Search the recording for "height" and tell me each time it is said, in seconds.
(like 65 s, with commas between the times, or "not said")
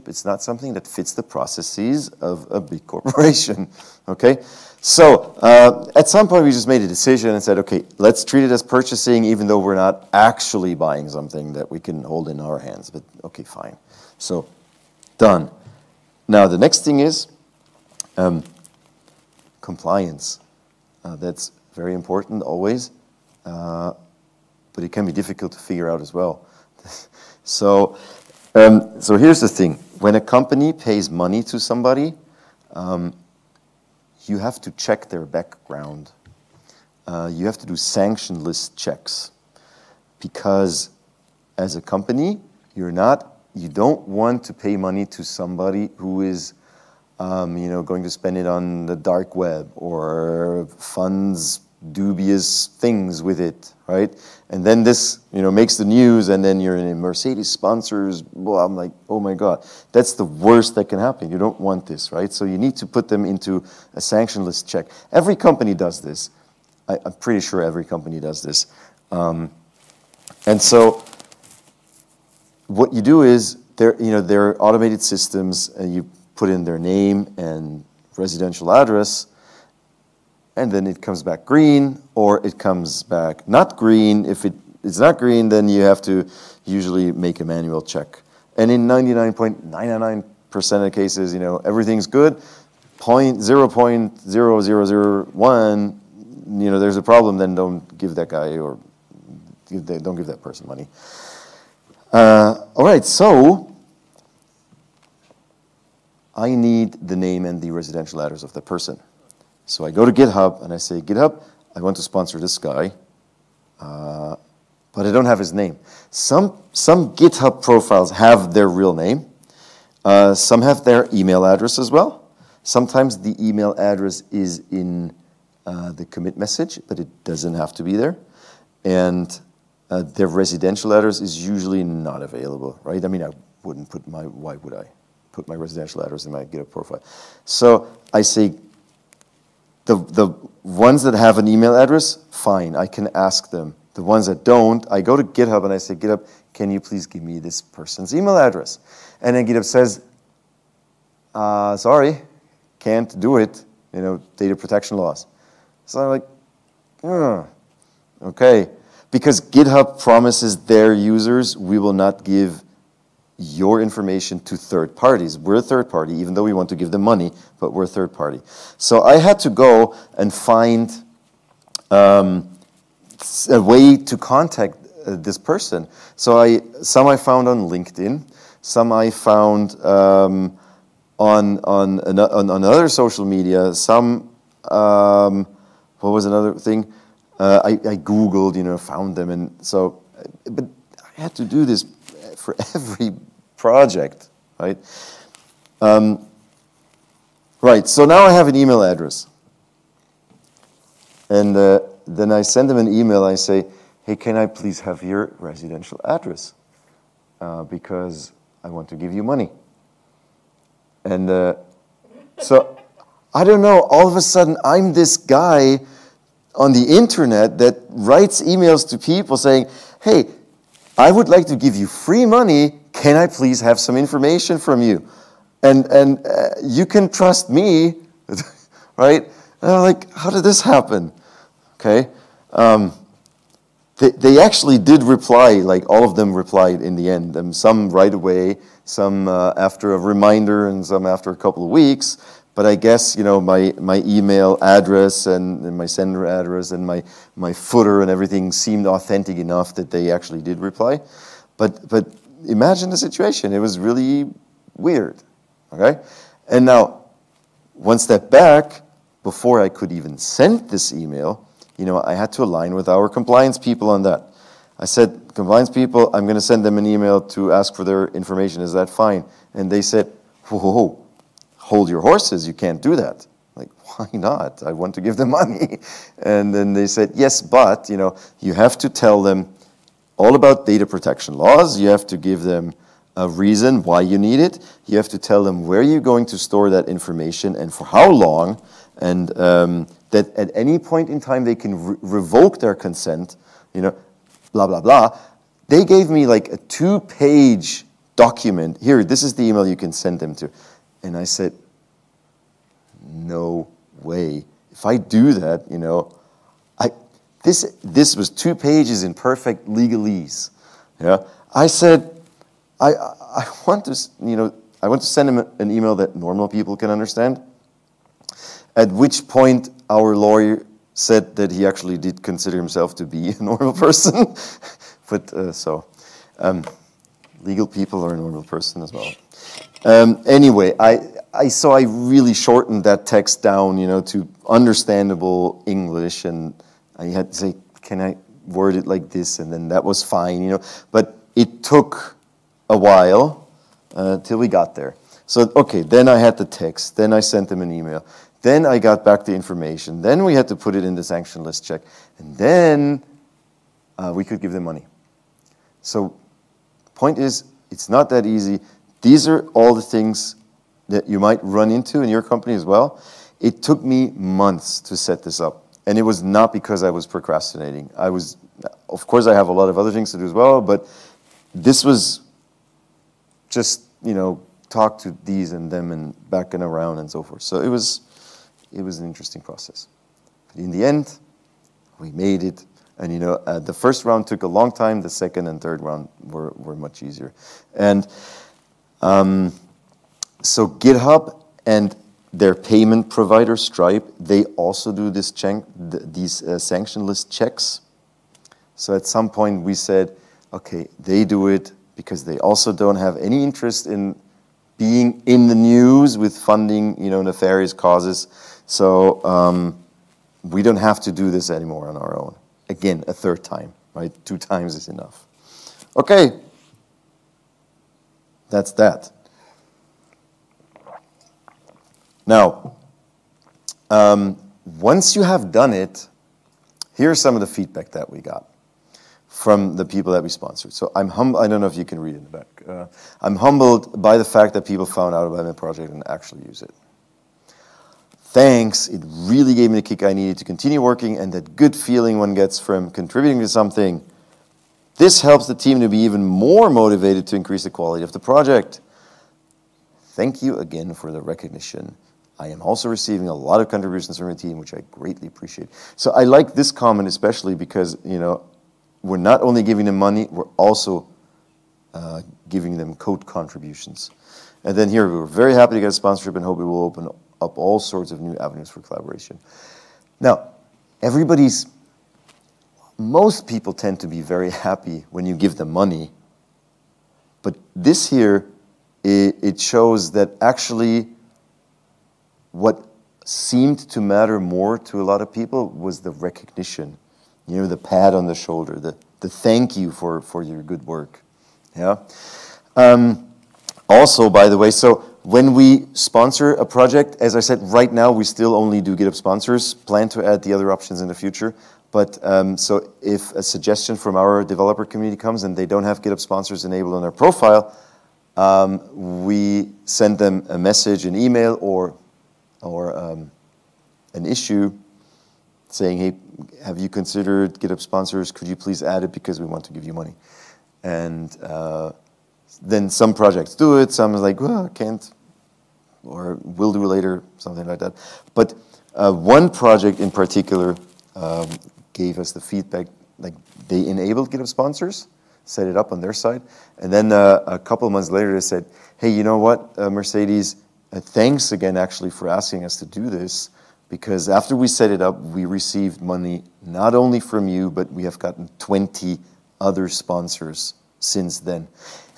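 not said.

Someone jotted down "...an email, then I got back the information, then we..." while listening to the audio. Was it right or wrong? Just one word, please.
right.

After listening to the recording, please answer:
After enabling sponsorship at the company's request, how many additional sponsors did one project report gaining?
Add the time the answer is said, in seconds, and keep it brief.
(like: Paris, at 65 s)
20, at 548 s.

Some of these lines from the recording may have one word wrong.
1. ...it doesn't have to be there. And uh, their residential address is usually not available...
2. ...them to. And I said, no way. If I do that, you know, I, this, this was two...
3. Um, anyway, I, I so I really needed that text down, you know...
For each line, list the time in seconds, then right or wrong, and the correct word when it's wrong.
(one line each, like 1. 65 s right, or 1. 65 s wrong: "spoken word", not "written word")
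1. 127 s right
2. 300 s right
3. 329 s wrong: "shortened", not "needed".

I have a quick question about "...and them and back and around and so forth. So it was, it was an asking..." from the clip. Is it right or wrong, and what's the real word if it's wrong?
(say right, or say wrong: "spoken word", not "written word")
wrong: "interesting", not "asking".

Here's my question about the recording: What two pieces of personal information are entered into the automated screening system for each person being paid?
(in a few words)
name and residential address.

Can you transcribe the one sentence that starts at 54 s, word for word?
And then this, you know, makes the news, and then you're in Mercedes sponsors.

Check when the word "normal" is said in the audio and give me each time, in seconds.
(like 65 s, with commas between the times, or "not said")
316 s, 323 s, 328 s.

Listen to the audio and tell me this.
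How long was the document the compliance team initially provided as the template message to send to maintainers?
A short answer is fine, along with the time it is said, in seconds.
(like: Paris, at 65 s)
two pages, at 296 s.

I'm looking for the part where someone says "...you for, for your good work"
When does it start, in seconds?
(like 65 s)
489 s.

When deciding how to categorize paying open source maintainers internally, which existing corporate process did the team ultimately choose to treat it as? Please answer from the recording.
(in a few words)
purchasing.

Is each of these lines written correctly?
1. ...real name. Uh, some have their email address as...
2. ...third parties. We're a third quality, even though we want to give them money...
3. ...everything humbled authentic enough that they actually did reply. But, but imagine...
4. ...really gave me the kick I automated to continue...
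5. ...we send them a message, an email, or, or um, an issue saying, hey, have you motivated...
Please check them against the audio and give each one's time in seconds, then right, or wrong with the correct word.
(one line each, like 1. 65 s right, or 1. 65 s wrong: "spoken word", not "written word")
1. 118 s right
2. 164 s wrong: "party", not "quality"
3. 248 s wrong: "seemed", not "humbled"
4. 439 s wrong: "needed", not "automated"
5. 509 s wrong: "considered", not "motivated".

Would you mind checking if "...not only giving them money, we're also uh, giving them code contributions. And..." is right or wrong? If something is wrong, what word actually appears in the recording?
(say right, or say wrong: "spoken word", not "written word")
right.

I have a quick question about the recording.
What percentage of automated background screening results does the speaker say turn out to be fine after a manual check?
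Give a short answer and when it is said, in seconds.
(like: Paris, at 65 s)
99.999%, at 88 s.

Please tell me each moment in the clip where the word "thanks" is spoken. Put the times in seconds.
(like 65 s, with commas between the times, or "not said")
438 s, 450 s, 489 s, 541 s.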